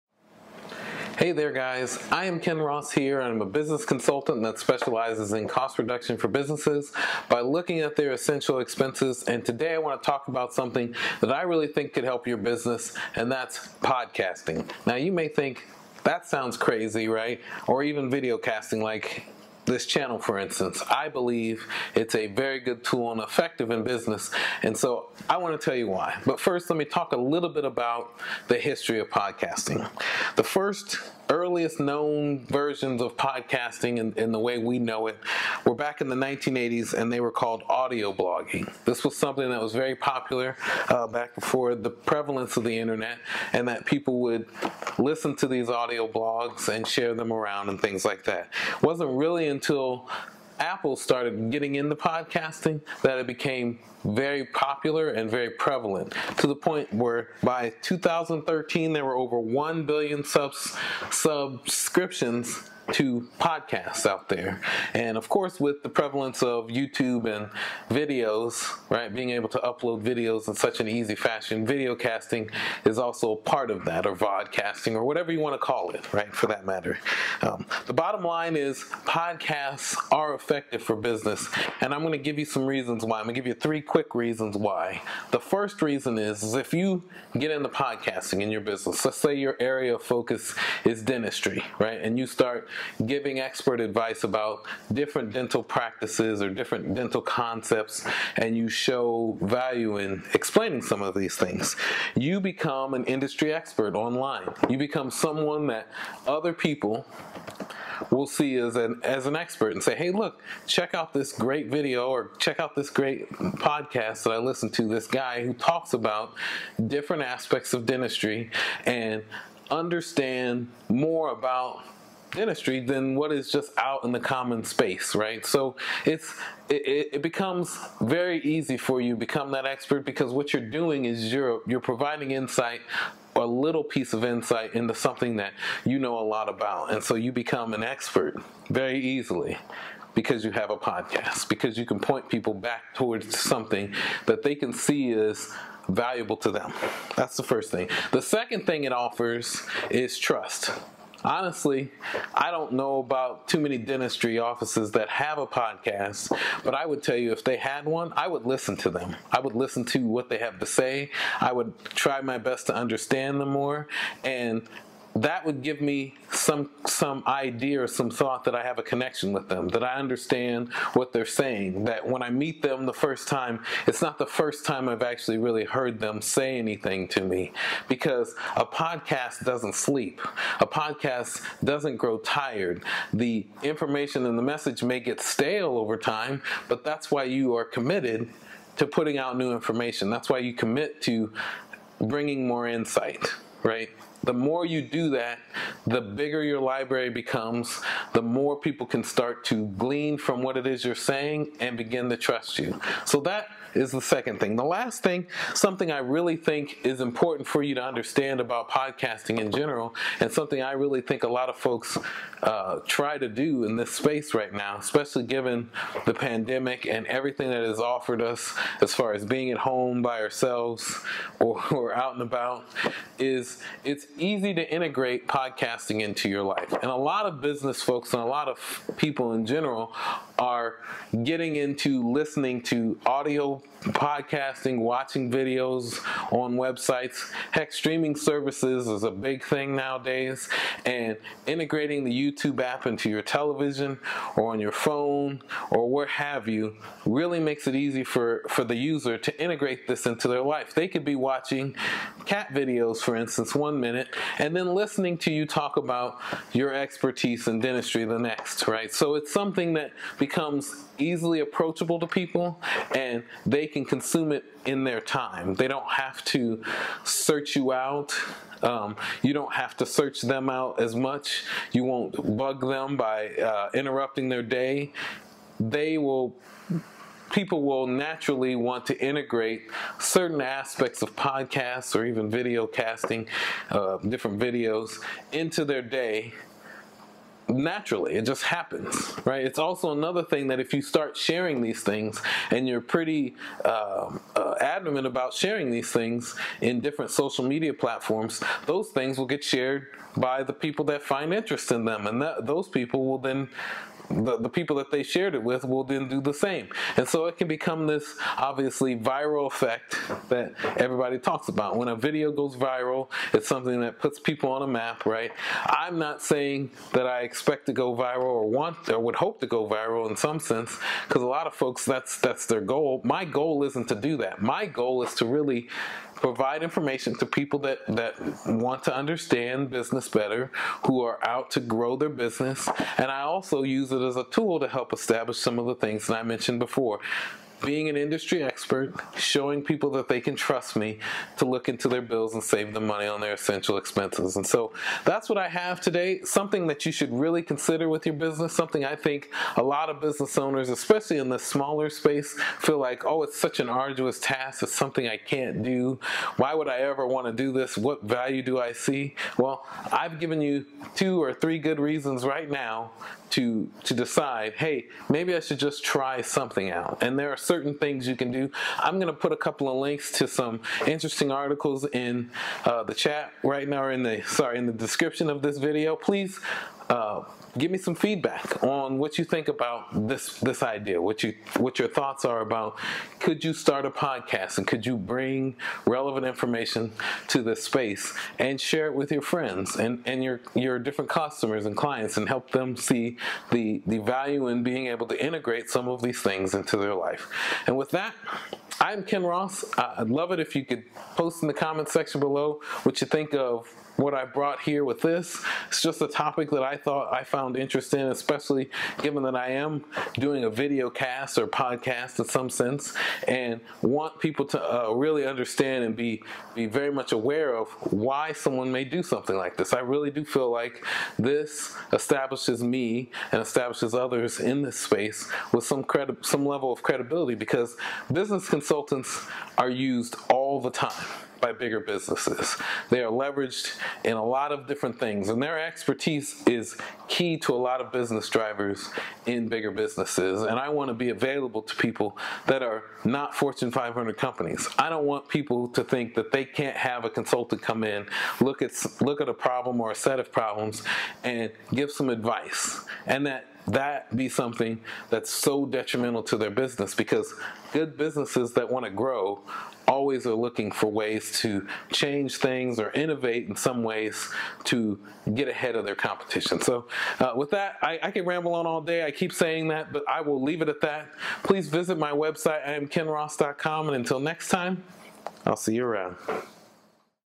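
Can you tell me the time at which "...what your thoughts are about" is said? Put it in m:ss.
6:21.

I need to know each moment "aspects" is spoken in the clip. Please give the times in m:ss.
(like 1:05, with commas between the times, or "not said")
1:57, 4:40.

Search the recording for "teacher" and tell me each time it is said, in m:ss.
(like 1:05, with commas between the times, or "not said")
not said.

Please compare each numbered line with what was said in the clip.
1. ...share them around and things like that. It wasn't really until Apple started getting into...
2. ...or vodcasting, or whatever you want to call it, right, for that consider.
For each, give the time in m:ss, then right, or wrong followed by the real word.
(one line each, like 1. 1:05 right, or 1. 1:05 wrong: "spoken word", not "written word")
1. 0:46 right
2. 1:14 wrong: "matter", not "consider".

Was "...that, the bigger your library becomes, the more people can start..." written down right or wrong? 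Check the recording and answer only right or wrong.
right.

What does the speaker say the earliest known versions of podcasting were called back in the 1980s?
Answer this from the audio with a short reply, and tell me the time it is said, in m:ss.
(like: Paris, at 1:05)
audio blogging, at 0:37.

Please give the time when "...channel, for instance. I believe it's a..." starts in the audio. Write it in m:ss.
0:19.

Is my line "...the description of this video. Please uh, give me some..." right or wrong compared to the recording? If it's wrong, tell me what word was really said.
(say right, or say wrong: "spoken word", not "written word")
right.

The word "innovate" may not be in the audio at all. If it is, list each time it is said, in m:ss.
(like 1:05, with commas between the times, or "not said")
7:42.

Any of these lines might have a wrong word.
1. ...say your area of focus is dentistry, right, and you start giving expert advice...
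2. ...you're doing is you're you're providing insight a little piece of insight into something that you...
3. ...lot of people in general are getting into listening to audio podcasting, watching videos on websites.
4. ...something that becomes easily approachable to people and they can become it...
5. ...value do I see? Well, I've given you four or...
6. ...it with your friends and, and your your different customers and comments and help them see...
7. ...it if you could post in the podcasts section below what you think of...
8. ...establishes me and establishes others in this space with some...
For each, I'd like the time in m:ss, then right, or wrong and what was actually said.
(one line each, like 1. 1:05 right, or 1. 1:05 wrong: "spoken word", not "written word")
1. 1:29 right
2. 2:10 right
3. 3:48 right
4. 4:19 wrong: "consume", not "become"
5. 5:58 wrong: "two", not "four"
6. 6:28 wrong: "clients", not "comments"
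7. 6:40 wrong: "comments", not "podcasts"
8. 7:01 right.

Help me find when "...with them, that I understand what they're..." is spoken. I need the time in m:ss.
2:49.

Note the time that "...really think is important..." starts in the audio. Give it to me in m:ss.
3:25.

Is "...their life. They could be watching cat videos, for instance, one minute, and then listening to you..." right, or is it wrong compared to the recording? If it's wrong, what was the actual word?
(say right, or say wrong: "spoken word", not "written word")
right.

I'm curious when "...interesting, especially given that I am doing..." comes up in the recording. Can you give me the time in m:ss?
6:47.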